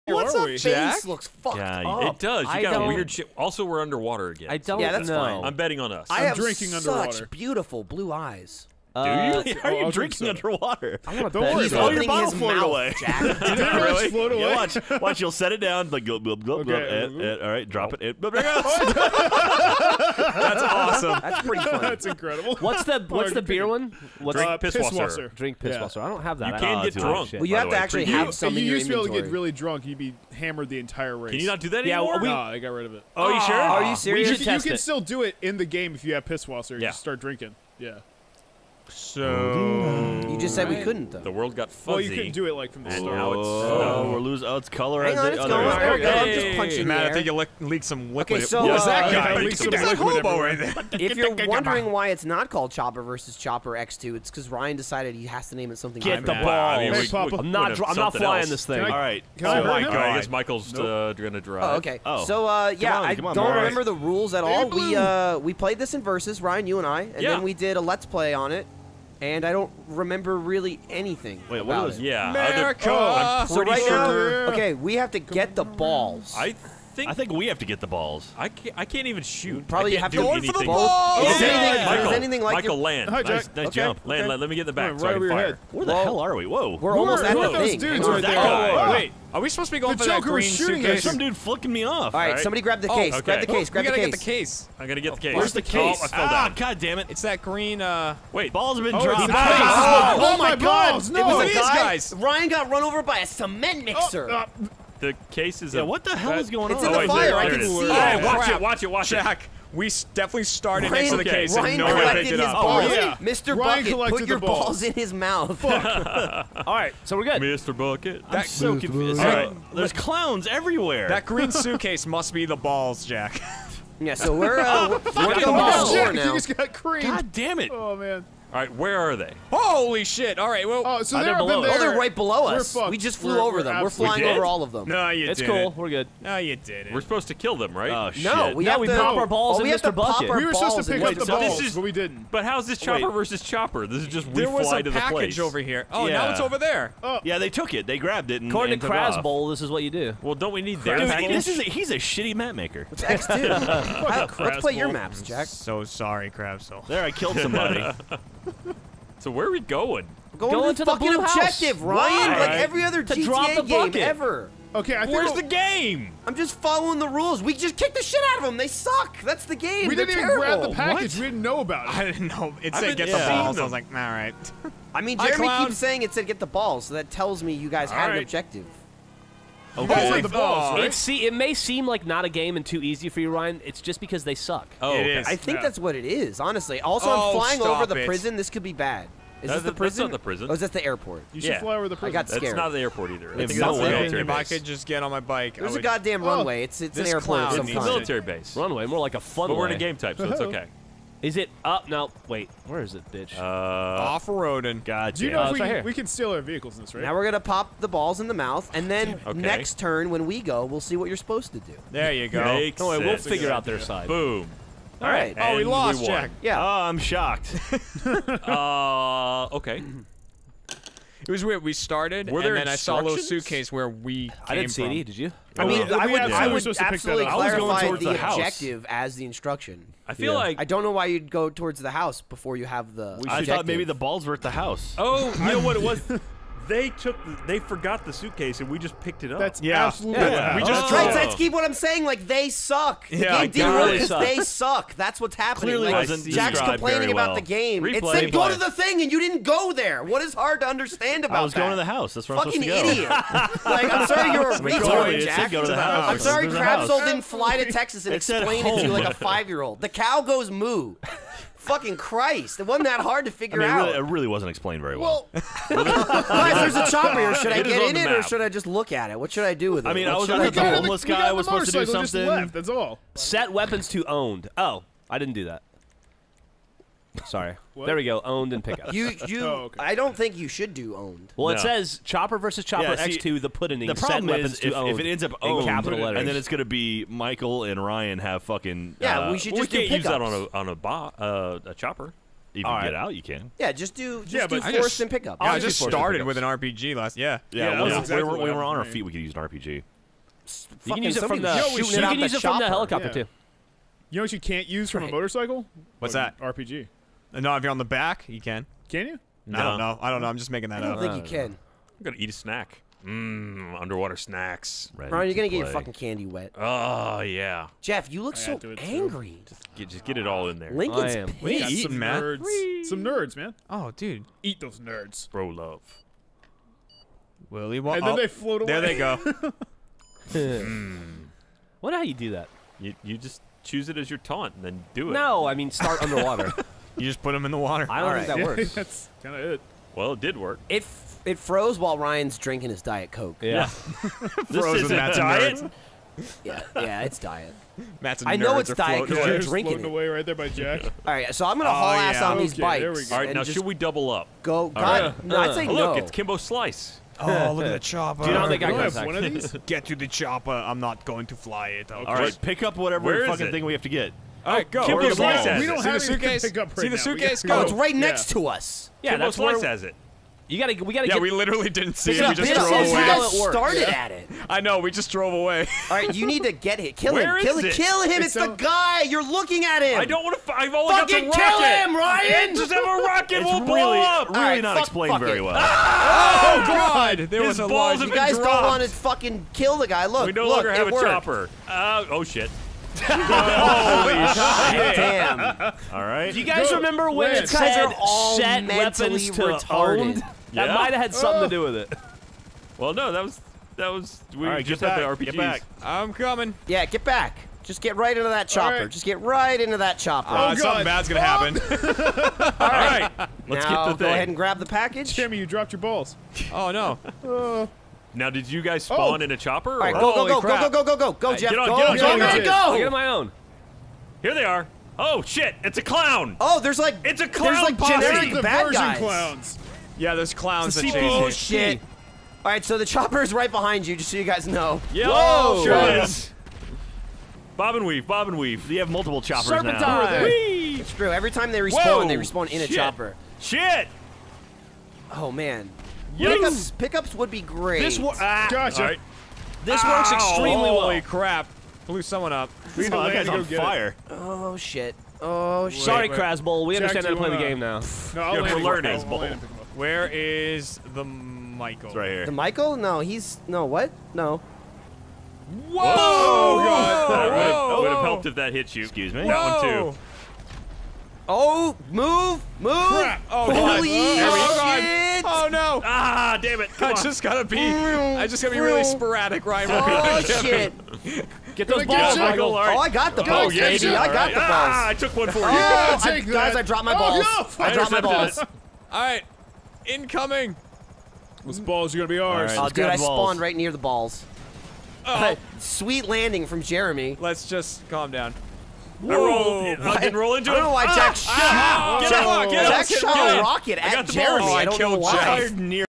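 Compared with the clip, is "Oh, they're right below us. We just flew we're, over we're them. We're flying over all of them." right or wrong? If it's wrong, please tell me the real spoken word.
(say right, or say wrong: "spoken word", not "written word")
right.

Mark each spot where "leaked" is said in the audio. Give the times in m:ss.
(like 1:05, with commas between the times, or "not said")
0:47.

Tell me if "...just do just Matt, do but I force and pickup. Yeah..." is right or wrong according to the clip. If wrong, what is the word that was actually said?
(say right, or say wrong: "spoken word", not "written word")
wrong: "Yeah", not "Matt".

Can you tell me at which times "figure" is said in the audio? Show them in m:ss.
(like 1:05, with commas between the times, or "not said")
3:33, 4:23.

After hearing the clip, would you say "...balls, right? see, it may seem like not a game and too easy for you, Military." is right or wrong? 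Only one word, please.
wrong.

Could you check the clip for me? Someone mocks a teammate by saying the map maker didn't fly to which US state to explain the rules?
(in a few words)
Texas.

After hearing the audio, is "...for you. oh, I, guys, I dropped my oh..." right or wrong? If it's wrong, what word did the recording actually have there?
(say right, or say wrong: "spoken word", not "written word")
right.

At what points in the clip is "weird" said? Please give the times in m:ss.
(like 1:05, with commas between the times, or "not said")
0:02, 3:41.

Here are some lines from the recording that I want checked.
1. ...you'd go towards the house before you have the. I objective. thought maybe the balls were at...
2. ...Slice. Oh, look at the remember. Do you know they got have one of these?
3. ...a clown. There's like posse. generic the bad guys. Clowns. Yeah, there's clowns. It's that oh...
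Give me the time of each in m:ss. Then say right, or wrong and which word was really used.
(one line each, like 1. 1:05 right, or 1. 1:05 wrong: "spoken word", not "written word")
1. 3:51 right
2. 5:56 wrong: "chopper", not "remember"
3. 7:07 right.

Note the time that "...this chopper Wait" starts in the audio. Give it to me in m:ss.
2:22.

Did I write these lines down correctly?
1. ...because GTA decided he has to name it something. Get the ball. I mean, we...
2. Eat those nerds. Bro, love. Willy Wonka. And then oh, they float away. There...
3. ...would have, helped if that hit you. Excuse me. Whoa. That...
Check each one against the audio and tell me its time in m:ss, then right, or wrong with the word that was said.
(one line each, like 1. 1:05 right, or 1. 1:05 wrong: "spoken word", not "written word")
1. 0:54 wrong: "Ryan", not "GTA"
2. 5:24 right
3. 7:47 right.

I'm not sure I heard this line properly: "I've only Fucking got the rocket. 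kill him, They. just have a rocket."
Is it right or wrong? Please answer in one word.
wrong.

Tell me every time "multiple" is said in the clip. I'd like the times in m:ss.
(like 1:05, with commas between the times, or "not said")
7:18.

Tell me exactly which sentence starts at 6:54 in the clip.
go ahead and grab the package.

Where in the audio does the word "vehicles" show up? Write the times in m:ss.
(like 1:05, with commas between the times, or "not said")
3:26.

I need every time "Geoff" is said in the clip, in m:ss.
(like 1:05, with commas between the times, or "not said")
5:17, 7:01.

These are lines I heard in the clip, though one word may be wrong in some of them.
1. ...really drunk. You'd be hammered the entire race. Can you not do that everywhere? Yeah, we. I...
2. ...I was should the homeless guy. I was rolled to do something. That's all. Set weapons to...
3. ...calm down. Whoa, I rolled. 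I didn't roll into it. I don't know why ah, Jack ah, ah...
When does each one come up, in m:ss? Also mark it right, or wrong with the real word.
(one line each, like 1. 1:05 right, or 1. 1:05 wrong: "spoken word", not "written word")
1. 0:29 wrong: "anymore", not "everywhere"
2. 4:30 wrong: "supposed", not "rolled"
3. 8:17 right.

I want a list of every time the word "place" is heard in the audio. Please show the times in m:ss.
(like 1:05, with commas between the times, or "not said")
2:25.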